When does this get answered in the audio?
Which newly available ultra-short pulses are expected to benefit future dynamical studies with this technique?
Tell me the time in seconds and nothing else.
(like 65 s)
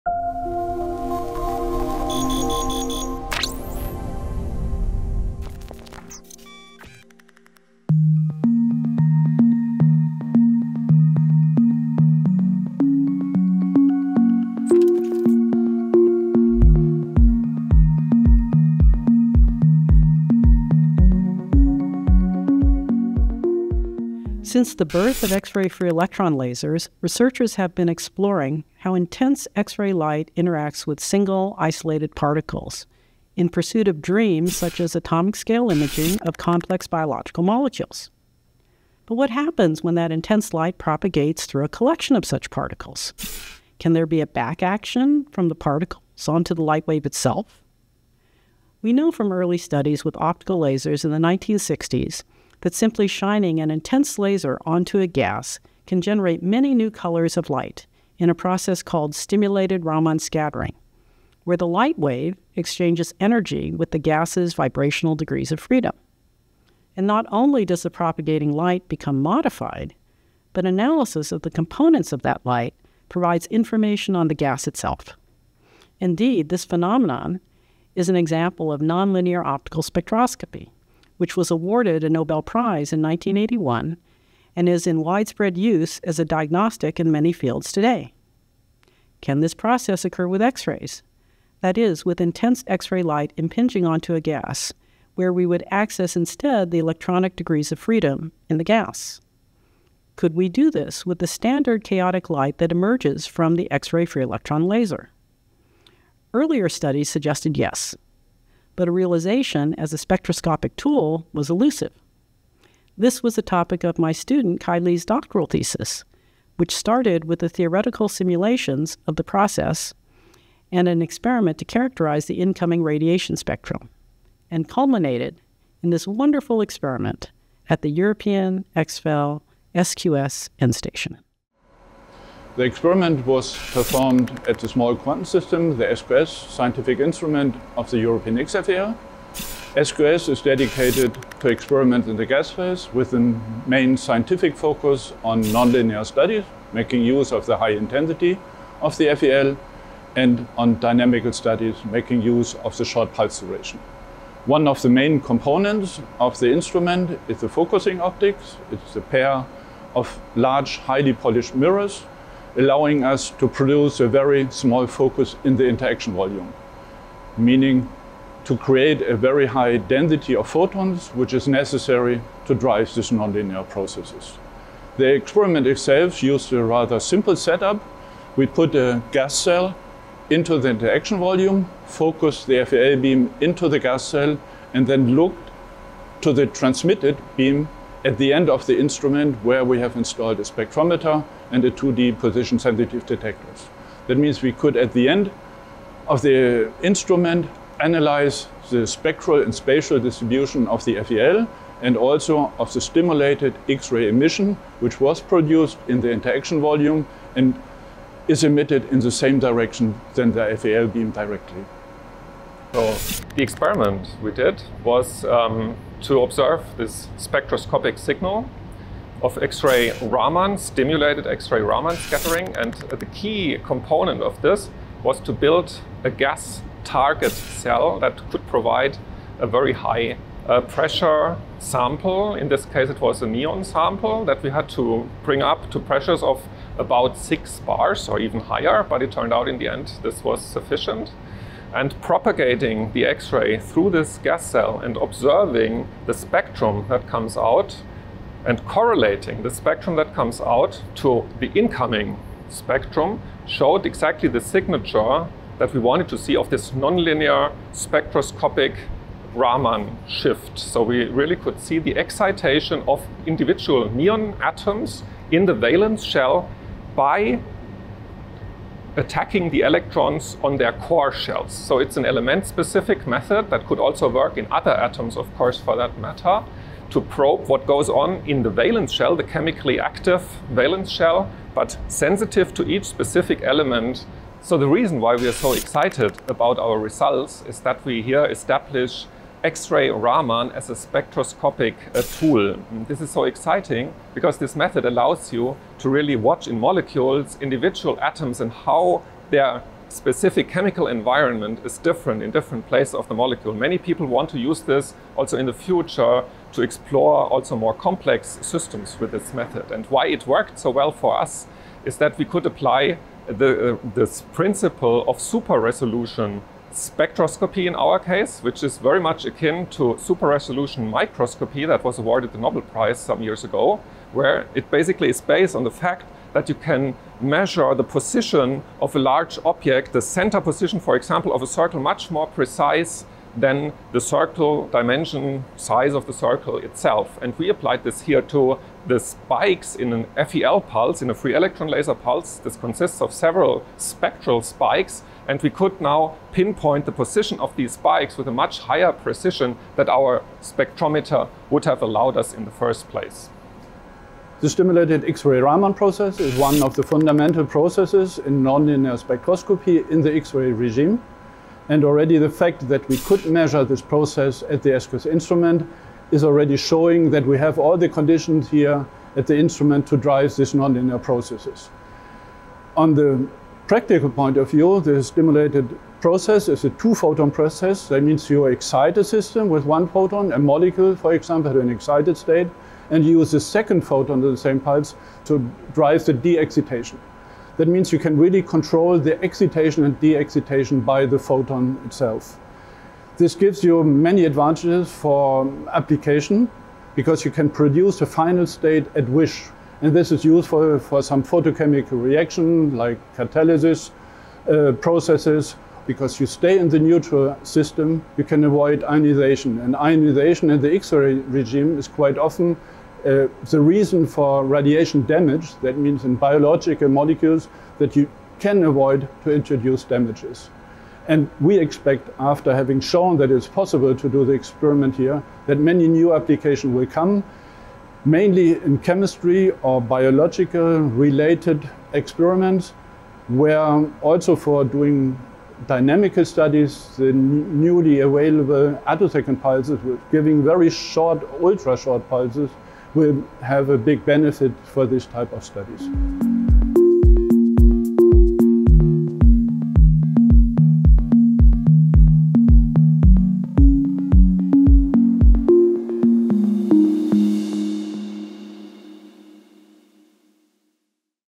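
438 s.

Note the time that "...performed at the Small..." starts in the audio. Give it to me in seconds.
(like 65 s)
133 s.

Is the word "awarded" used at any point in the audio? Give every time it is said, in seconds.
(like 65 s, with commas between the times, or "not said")
81 s, 321 s.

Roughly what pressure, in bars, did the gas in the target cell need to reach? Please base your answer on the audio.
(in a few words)
6 bars.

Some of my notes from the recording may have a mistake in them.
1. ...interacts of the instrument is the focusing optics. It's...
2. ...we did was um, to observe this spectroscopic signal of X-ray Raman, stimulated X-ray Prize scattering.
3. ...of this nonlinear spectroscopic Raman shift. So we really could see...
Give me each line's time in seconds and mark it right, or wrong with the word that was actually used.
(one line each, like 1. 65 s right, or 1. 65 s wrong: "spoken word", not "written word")
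1. 155 s wrong: "components", not "interacts"
2. 214 s wrong: "Raman", not "Prize"
3. 256 s right.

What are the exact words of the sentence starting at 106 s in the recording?
Earlier studies suggested yes, but a realization as a spectroscopic tool was elusive.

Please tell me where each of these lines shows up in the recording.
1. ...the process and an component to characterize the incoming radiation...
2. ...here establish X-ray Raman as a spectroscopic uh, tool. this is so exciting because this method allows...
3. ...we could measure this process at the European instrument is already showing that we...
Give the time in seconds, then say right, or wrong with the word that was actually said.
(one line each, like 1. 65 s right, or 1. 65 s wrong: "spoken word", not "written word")
1. 119 s wrong: "experiment", not "component"
2. 288 s right
3. 362 s wrong: "SQS", not "European".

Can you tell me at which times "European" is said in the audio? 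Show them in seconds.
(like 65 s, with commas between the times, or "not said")
127 s, 137 s.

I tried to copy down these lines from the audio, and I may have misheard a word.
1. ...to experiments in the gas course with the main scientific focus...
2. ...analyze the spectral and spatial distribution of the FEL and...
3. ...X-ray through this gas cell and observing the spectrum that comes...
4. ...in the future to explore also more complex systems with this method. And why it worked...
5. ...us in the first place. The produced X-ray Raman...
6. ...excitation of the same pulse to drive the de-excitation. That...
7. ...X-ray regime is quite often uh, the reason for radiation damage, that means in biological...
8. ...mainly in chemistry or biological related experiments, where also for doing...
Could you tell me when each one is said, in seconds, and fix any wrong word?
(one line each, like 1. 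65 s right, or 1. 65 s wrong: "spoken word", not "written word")
1. 141 s wrong: "phase", not "course"
2. 197 s right
3. 243 s right
4. 305 s right
5. 352 s wrong: "stimulated", not "produced"
6. 383 s wrong: "photon", not "excitation"
7. 410 s right
8. 428 s right.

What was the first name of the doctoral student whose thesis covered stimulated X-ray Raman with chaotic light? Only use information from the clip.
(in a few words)
Kai.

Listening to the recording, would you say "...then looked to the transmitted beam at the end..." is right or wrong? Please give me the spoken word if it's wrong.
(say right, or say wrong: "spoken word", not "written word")
right.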